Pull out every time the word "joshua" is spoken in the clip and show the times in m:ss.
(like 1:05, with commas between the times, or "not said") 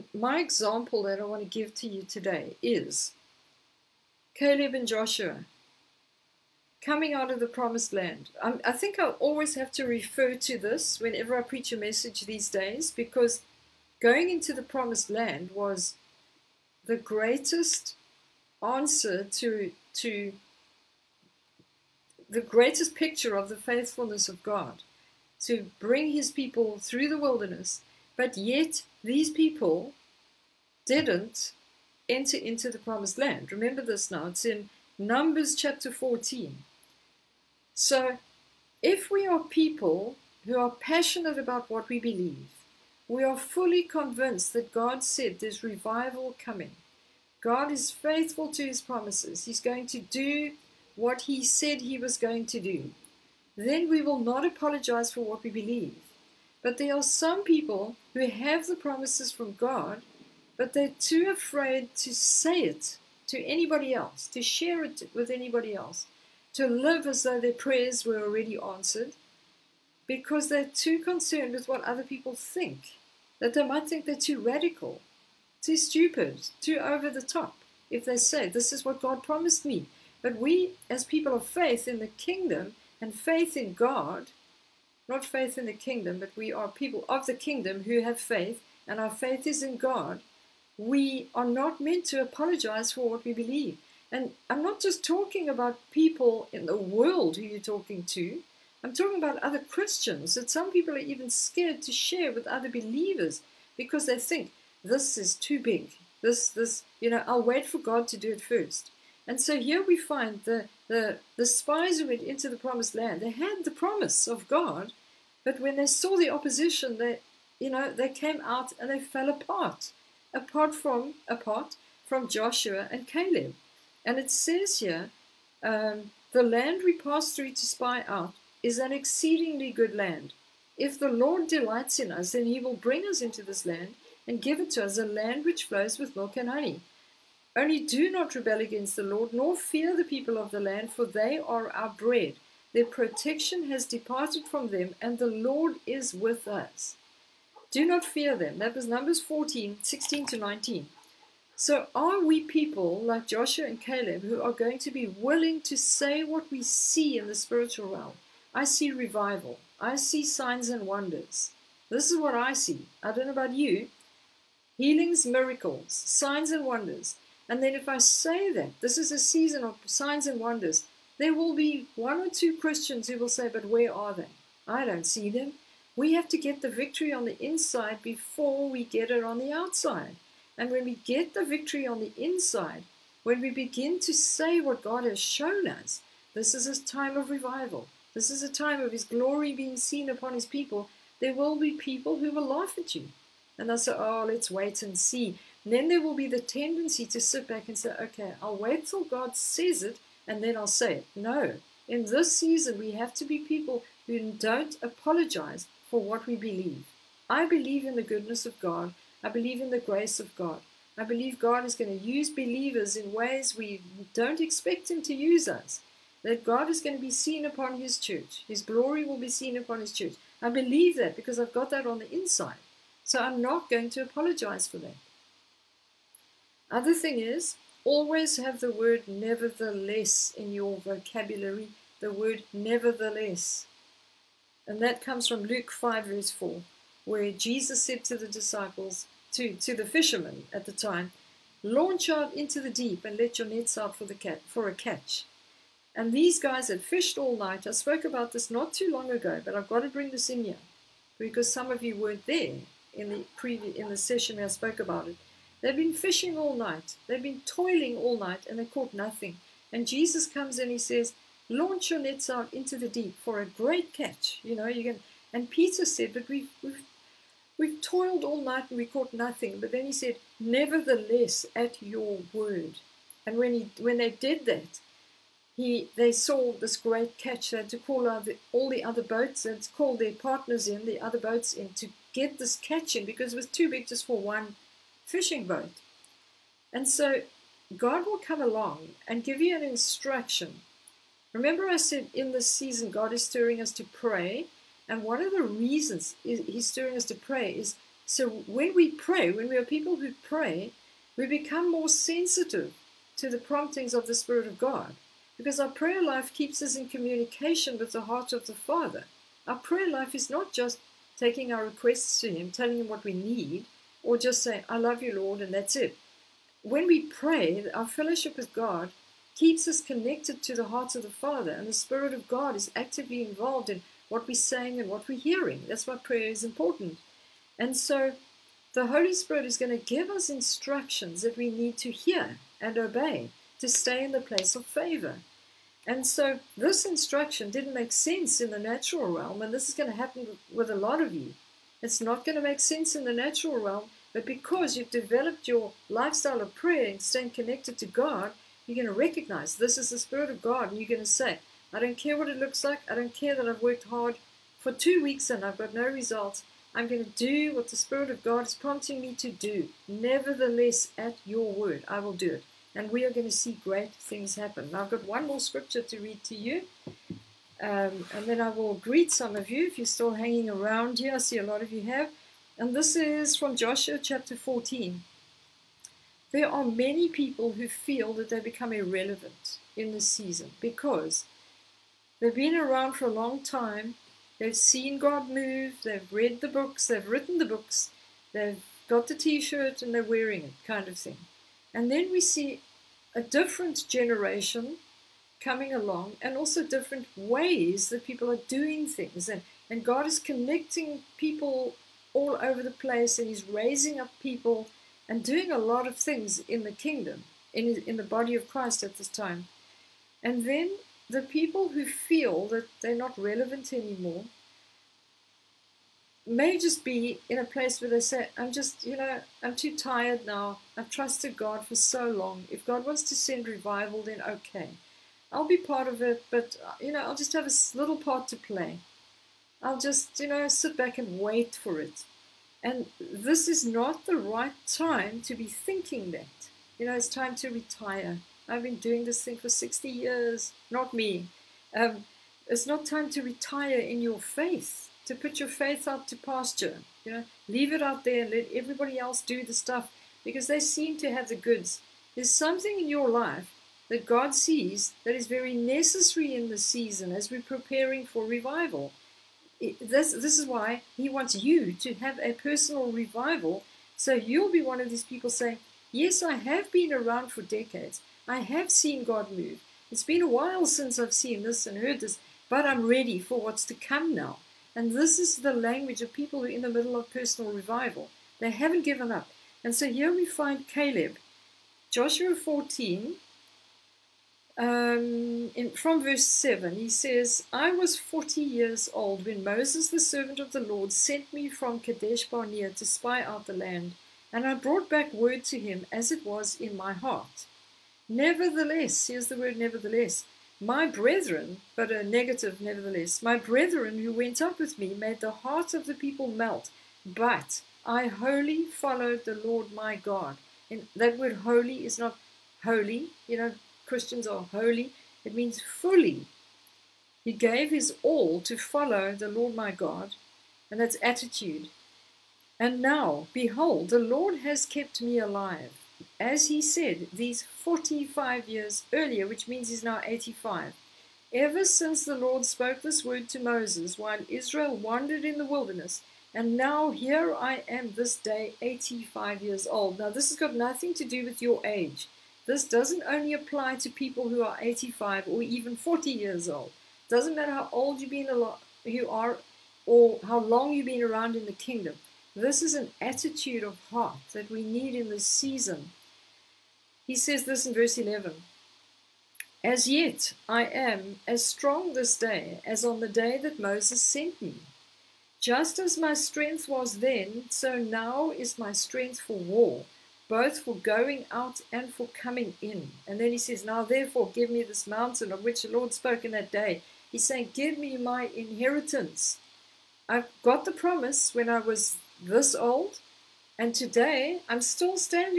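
0:04, 2:02, 2:33, 6:13, 8:01.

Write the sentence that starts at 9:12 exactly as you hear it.
This is an attitude of heart that we need in this season.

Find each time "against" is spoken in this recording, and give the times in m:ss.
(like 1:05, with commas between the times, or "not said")
2:18.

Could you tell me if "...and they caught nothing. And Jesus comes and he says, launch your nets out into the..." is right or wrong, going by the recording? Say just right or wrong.
right.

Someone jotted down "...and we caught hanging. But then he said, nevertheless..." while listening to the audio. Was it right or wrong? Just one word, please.
wrong.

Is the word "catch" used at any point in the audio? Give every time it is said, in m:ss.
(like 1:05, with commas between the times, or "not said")
4:04, 4:23, 4:37, 4:42.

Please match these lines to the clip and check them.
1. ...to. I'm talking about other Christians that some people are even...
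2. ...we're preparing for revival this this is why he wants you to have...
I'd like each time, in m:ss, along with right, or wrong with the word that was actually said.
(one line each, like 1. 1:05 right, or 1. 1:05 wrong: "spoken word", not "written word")
1. 1:38 right
2. 7:37 right.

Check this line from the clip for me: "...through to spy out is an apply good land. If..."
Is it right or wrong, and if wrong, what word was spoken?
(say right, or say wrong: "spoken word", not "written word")
wrong: "exceedingly", not "apply".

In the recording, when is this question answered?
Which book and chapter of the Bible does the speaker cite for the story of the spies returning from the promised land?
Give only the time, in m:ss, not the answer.
0:34.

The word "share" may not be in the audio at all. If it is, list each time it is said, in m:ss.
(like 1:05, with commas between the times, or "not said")
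1:04, 1:41.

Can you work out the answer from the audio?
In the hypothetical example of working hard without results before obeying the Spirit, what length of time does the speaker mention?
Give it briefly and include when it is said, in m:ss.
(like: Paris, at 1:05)
Two weeks, at 5:54.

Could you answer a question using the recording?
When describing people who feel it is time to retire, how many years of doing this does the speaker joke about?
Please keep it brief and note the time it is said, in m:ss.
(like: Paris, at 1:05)
60 years, at 7:19.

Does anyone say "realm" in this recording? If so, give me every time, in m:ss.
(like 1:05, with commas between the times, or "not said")
2:37, 5:39, 5:43.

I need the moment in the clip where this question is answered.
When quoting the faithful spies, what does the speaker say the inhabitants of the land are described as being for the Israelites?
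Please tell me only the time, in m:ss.
2:21.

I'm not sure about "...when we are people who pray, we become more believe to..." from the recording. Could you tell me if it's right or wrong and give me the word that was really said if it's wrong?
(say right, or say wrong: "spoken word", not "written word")
wrong: "sensitive", not "believe".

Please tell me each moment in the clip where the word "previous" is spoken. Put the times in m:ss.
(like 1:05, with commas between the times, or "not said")
4:13.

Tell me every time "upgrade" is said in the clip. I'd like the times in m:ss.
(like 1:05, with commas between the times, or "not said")
not said.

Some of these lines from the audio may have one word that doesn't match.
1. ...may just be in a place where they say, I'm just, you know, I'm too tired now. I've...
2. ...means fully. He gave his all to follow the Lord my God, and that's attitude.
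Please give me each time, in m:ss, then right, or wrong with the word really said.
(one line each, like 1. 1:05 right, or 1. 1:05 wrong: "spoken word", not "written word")
1. 6:56 right
2. 8:35 right.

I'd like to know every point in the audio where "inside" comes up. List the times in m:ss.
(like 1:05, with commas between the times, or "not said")
2:57, 3:02, 3:42.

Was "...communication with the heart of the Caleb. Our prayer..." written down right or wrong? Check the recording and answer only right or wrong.
wrong.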